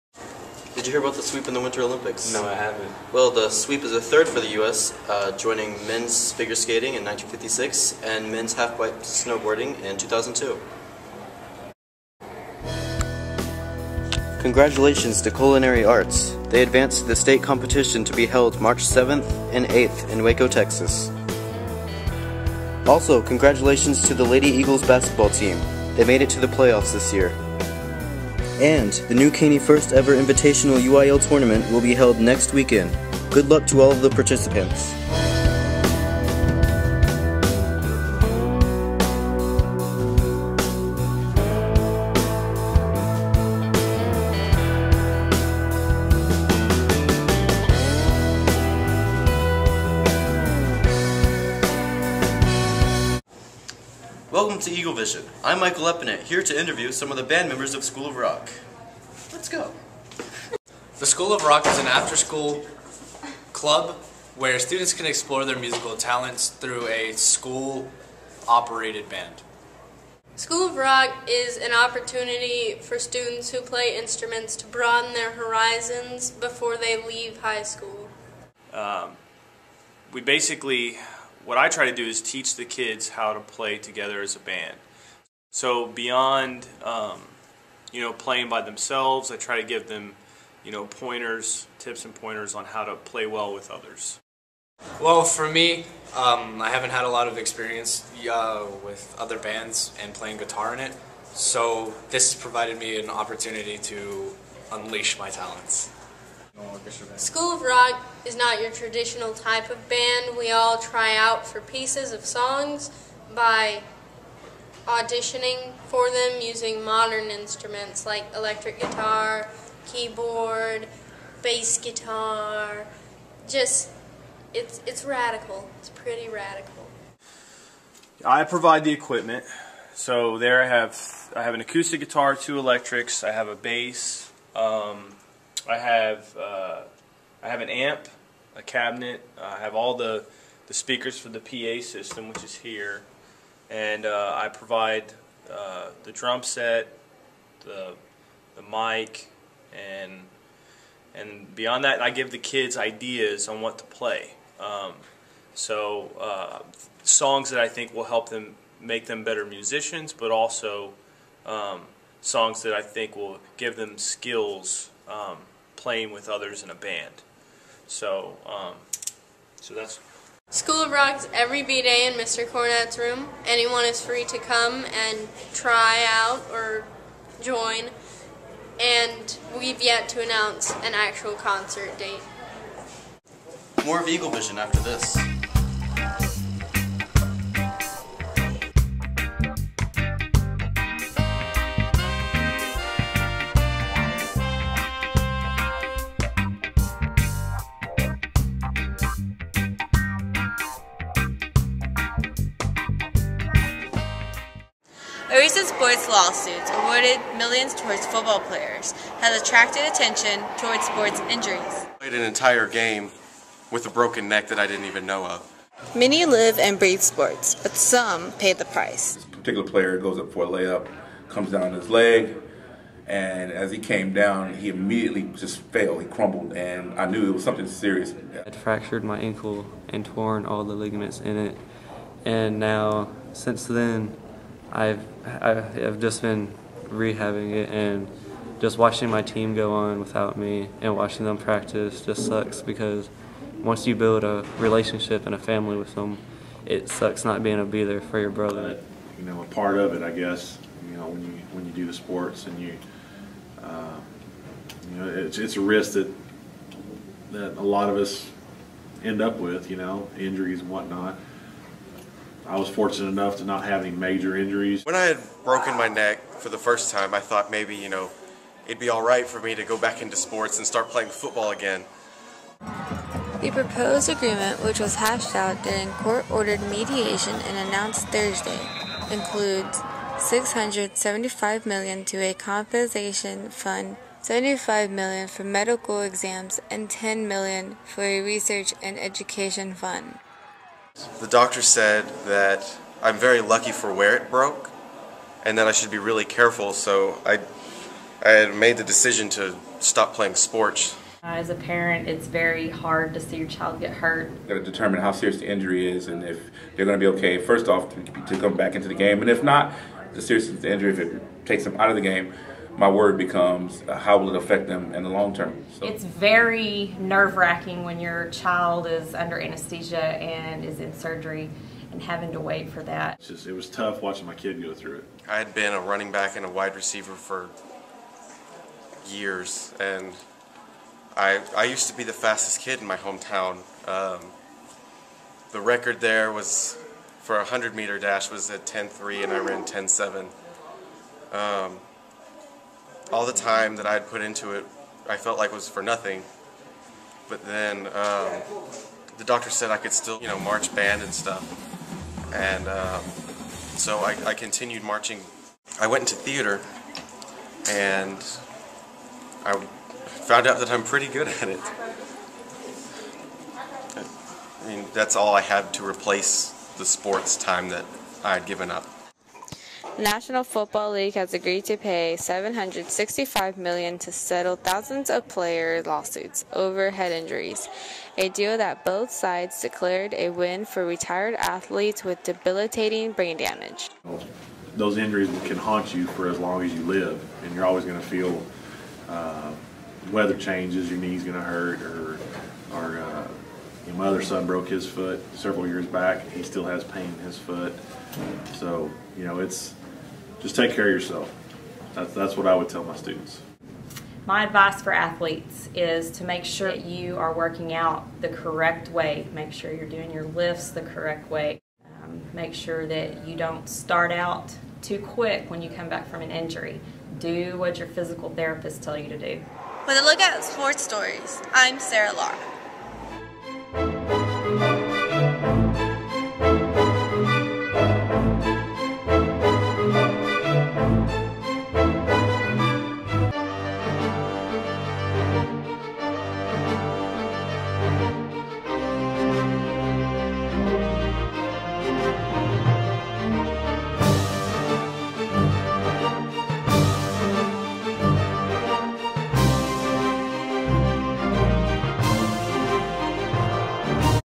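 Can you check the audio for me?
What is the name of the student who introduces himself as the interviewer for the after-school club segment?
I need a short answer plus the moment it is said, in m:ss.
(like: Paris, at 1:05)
Michael Epinet, at 0:55.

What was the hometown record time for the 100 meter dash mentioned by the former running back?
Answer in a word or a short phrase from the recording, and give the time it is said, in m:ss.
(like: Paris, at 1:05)
10.3, at 5:38.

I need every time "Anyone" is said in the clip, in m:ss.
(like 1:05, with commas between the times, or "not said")
2:53.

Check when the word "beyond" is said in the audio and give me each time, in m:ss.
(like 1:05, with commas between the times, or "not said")
1:25, 2:31.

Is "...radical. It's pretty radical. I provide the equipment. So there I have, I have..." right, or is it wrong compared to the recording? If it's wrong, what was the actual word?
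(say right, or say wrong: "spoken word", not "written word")
right.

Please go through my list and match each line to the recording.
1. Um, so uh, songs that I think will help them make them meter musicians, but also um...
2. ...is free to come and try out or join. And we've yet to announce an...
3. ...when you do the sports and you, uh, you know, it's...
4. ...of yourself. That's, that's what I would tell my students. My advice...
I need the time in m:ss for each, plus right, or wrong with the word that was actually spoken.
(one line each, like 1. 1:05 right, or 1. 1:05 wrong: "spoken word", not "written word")
1. 2:34 wrong: "better", not "meter"
2. 2:53 right
3. 4:11 right
4. 6:40 right.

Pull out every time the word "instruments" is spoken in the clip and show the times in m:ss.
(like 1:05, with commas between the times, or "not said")
1:13, 1:57.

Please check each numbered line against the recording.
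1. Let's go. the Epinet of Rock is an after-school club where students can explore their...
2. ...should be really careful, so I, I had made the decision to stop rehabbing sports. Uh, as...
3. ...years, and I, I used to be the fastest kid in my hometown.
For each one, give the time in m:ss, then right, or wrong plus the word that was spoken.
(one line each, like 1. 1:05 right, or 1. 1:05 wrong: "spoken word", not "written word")
1. 0:59 wrong: "School", not "Epinet"
2. 4:55 wrong: "playing", not "rehabbing"
3. 5:29 right.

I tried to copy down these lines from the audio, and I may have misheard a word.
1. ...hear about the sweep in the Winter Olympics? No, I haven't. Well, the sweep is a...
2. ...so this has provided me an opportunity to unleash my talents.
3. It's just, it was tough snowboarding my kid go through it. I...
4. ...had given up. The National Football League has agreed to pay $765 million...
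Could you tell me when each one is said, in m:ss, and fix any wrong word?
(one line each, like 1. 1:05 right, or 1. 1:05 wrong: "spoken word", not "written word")
1. 0:00 right
2. 1:41 right
3. 5:23 wrong: "watching", not "snowboarding"
4. 6:08 right.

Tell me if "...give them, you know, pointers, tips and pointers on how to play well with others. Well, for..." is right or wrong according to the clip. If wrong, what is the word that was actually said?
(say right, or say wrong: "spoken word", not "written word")
right.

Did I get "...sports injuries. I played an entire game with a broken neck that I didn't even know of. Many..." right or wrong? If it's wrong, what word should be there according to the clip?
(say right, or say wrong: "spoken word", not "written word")
right.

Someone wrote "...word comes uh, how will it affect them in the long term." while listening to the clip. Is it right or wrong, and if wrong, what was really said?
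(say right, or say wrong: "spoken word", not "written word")
wrong: "becomes", not "comes".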